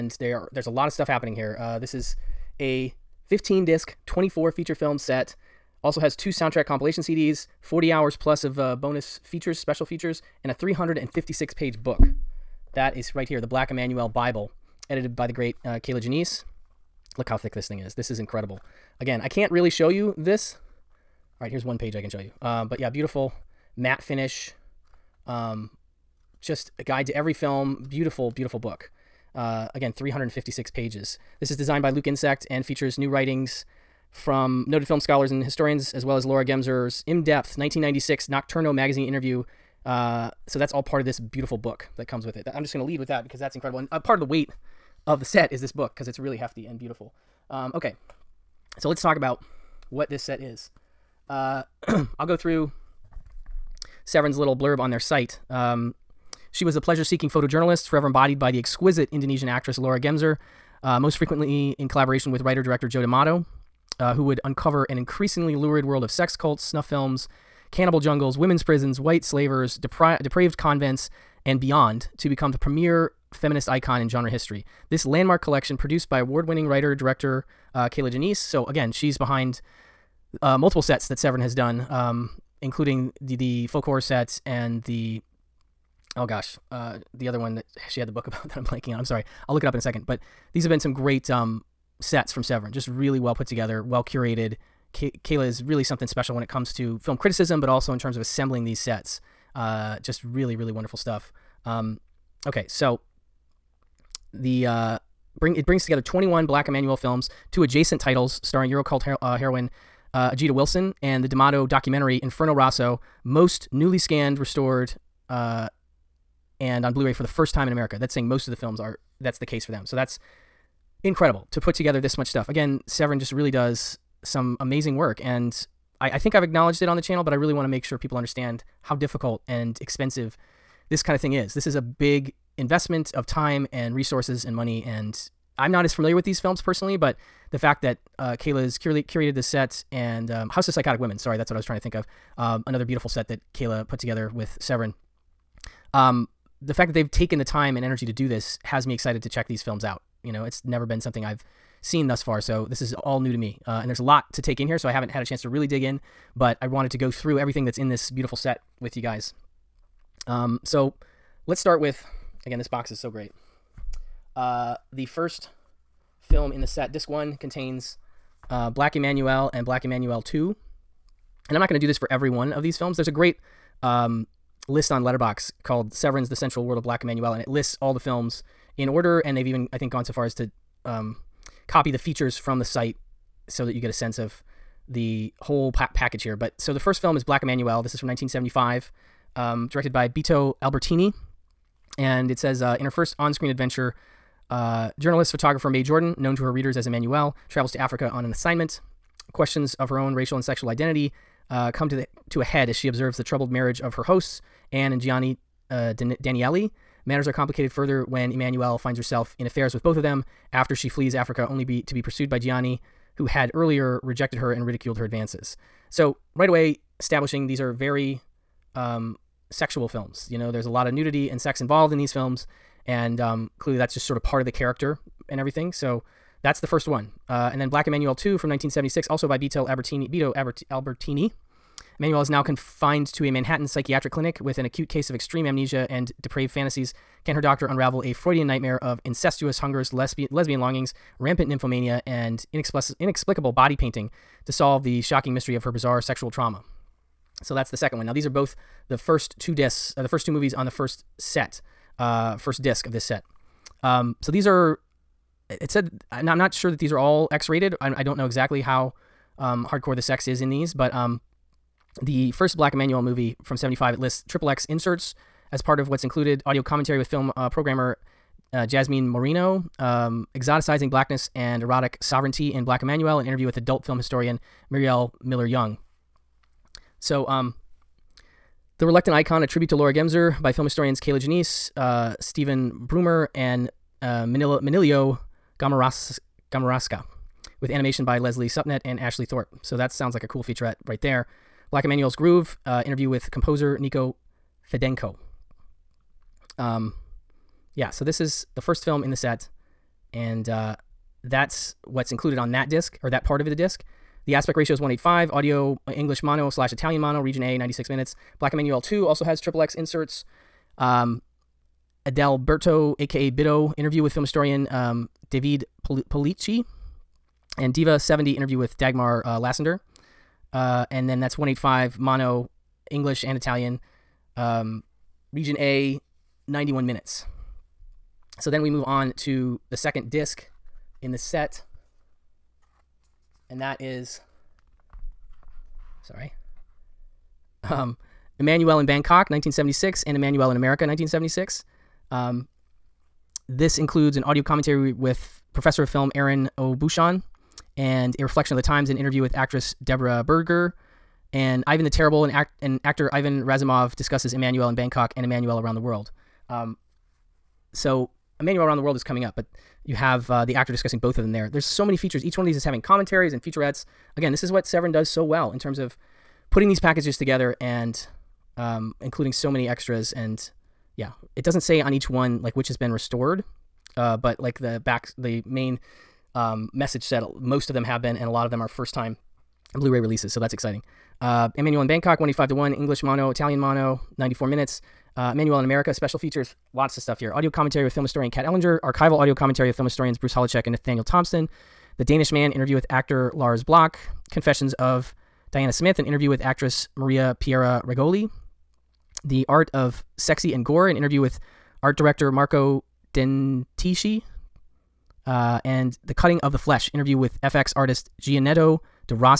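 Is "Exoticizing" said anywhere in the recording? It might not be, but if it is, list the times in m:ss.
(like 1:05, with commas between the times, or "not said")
4:30.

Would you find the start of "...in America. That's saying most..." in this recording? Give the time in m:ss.
1:57.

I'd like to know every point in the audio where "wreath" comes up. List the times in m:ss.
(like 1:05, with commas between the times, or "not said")
not said.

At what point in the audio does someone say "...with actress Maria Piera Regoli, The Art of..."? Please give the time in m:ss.
6:36.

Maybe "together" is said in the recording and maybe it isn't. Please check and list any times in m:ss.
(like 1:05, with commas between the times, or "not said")
1:33, 1:45, 2:01, 2:23, 6:07.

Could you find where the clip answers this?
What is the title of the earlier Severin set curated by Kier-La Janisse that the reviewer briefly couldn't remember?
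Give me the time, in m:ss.
2:20.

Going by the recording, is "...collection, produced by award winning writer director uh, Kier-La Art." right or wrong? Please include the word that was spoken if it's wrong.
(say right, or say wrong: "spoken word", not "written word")
wrong: "Janisse", not "Art".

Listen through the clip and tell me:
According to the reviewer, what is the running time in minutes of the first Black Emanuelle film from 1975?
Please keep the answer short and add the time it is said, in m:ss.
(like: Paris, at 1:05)
96 minutes, at 5:07.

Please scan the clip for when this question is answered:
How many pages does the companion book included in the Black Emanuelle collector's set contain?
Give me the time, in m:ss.
0:10.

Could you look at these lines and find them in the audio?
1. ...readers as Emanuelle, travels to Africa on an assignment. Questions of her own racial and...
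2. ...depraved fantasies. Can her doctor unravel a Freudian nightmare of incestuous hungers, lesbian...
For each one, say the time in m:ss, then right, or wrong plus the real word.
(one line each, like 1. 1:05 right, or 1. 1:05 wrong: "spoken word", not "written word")
1. 3:16 right
2. 3:56 right.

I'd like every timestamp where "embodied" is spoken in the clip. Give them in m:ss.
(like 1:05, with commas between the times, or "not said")
0:58.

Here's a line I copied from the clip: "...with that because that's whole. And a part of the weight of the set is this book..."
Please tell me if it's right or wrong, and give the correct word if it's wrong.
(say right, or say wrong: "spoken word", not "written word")
wrong: "incredible", not "whole".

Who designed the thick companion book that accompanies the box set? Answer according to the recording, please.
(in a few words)
Luke Insect.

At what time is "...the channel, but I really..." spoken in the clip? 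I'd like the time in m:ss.
2:06.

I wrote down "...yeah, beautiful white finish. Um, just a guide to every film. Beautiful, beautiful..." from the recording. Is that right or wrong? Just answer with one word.
wrong.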